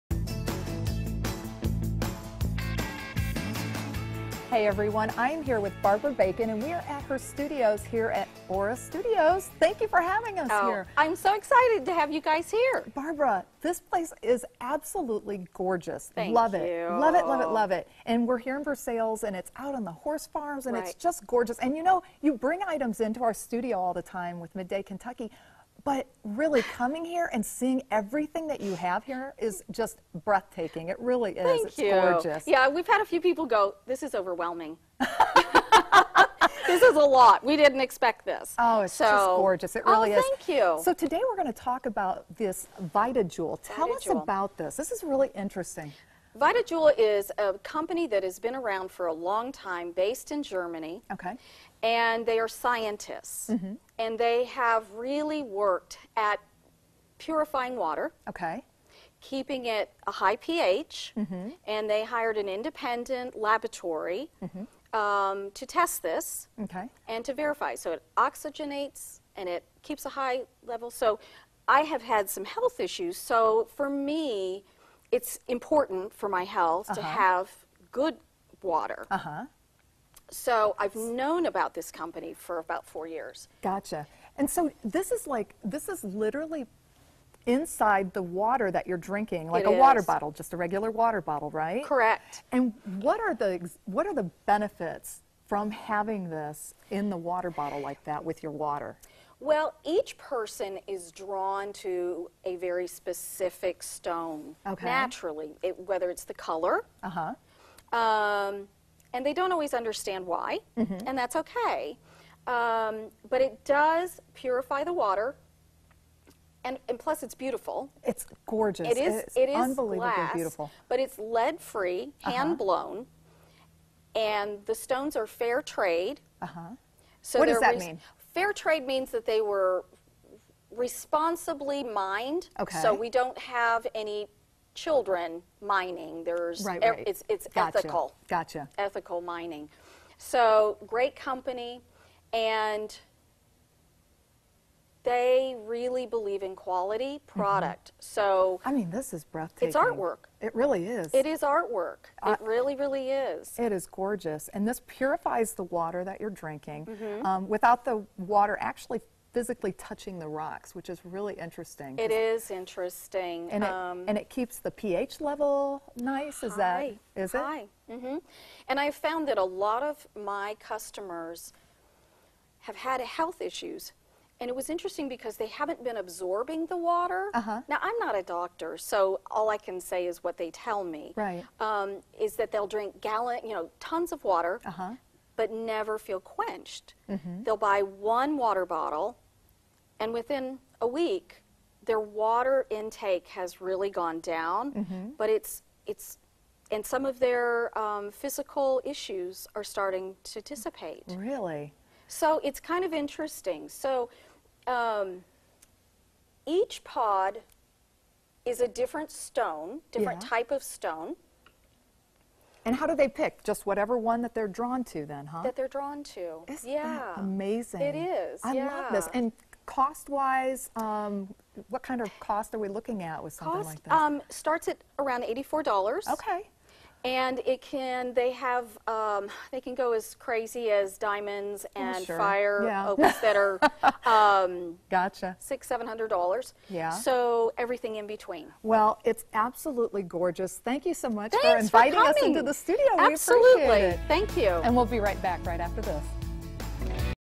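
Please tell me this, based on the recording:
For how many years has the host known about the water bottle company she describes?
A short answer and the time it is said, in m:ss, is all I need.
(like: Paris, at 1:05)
4 years, at 1:22.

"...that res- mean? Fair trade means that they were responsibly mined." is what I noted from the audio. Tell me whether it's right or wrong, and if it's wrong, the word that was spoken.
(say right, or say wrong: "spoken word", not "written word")
right.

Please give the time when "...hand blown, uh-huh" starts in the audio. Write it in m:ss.
2:02.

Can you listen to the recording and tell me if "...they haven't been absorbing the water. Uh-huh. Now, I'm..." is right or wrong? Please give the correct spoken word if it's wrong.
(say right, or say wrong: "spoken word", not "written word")
right.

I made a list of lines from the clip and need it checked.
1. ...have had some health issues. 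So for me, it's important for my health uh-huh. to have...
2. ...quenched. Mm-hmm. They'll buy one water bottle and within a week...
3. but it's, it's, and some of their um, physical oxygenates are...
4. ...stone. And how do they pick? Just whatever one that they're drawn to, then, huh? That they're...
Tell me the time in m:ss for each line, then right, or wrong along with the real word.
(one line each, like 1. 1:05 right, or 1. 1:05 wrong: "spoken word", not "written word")
1. 1:11 right
2. 3:06 right
3. 3:15 wrong: "issues", not "oxygenates"
4. 3:30 right.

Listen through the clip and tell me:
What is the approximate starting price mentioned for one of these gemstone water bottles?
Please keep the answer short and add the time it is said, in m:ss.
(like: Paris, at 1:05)
$84, at 3:45.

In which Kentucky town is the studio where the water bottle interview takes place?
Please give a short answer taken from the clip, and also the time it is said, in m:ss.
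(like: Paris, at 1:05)
Versailles, at 0:18.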